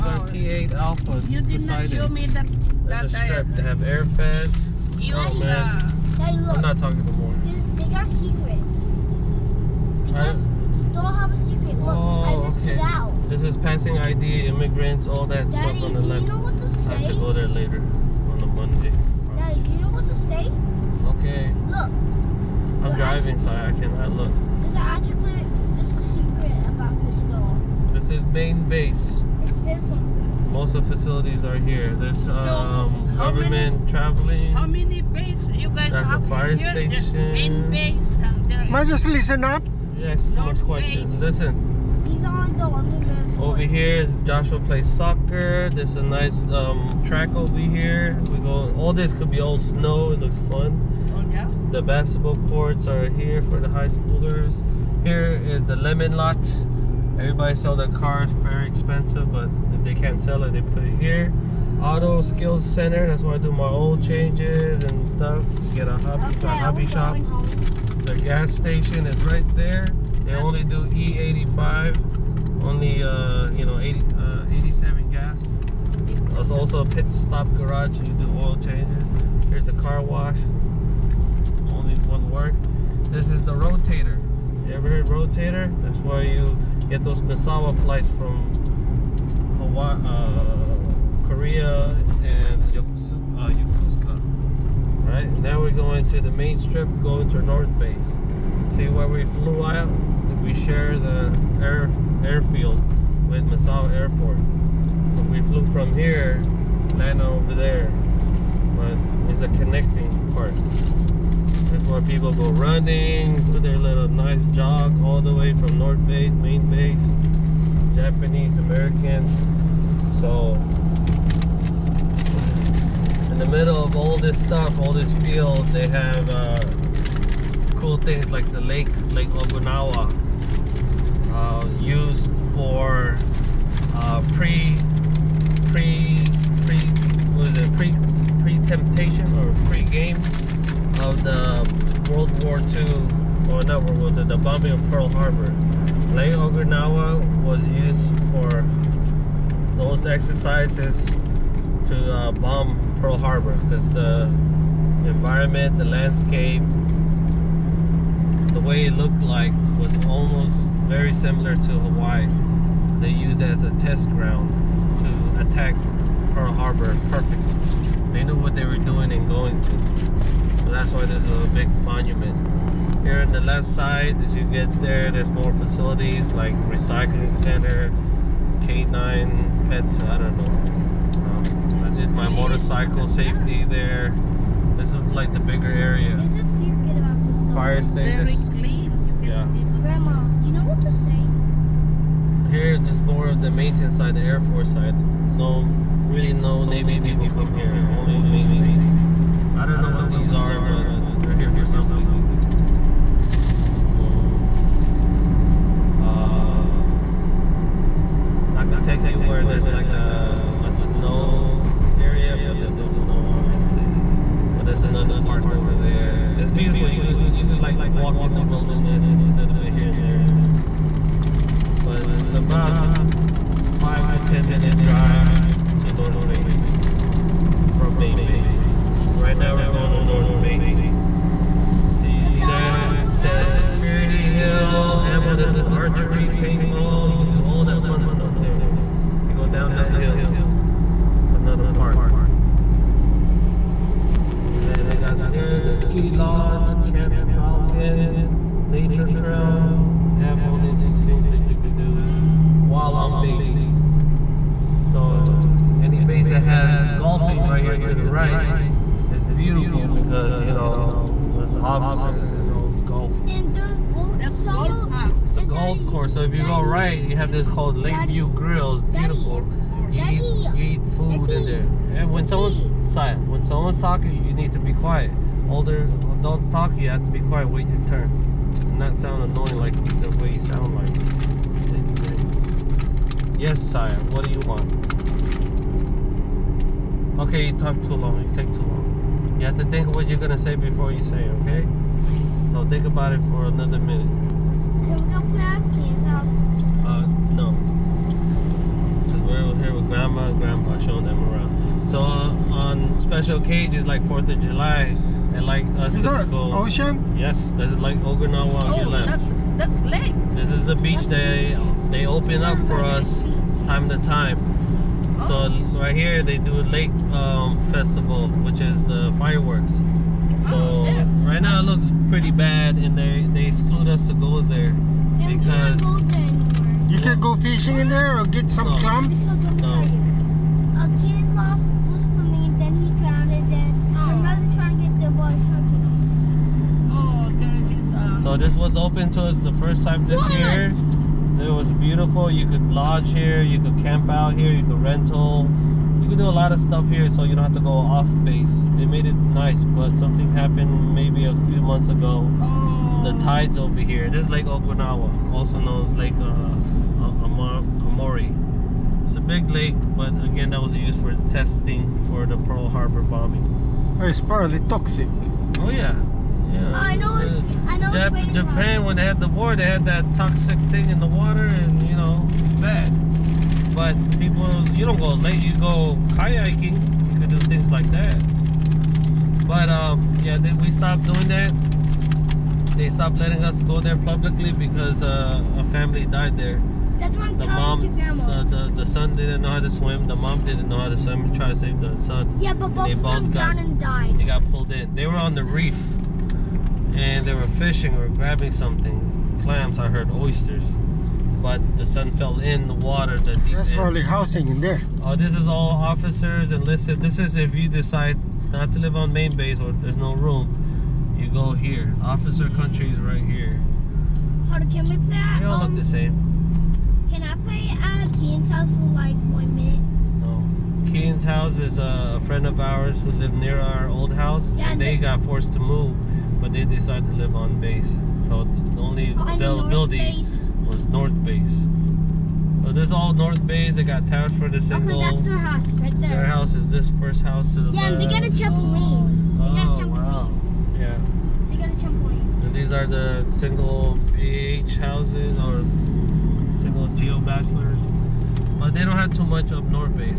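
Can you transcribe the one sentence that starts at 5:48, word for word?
They made it nice, but something happened maybe a few months ago.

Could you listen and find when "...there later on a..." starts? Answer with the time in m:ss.
0:17.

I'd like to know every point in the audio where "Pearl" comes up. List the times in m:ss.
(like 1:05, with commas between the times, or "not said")
2:24, 2:32, 2:46, 6:02.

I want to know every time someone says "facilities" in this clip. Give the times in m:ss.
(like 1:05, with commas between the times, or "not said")
0:30, 2:55.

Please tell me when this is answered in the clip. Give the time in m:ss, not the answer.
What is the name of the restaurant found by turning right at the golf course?
4:27.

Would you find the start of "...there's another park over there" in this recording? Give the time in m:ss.
3:34.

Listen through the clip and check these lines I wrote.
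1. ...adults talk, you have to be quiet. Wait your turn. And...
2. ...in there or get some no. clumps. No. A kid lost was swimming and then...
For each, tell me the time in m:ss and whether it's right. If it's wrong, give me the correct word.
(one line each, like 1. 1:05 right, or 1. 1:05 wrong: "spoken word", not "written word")
1. 4:36 right
2. 5:27 right.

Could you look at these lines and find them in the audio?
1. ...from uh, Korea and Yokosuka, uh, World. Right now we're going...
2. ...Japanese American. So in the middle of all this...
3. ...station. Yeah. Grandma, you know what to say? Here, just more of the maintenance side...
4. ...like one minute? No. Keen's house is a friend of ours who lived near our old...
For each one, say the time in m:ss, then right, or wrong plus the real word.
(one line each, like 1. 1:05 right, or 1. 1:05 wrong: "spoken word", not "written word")
1. 1:28 wrong: "Yokosuka", not "World"
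2. 1:57 right
3. 3:07 right
4. 6:58 right.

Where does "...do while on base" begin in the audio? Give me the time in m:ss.
4:11.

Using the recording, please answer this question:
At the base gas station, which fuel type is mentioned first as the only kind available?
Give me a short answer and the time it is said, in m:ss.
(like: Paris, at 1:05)
E85, at 1:10.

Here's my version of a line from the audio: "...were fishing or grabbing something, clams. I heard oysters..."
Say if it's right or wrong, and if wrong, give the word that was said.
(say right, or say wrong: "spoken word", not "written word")
right.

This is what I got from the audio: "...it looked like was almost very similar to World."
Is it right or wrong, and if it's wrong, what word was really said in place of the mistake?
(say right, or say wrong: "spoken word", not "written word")
wrong: "Hawaii", not "World".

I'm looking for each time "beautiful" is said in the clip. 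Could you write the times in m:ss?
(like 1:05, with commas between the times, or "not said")
3:36, 4:19, 4:28, 5:41.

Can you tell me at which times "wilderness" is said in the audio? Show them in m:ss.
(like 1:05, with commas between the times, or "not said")
3:38.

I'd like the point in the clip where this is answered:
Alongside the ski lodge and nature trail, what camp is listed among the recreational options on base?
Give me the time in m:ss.
4:06.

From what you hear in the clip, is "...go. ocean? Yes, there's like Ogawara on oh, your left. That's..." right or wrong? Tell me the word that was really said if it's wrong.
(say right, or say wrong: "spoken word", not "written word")
right.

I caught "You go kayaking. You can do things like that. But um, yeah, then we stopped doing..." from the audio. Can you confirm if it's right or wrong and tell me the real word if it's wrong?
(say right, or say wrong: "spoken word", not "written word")
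right.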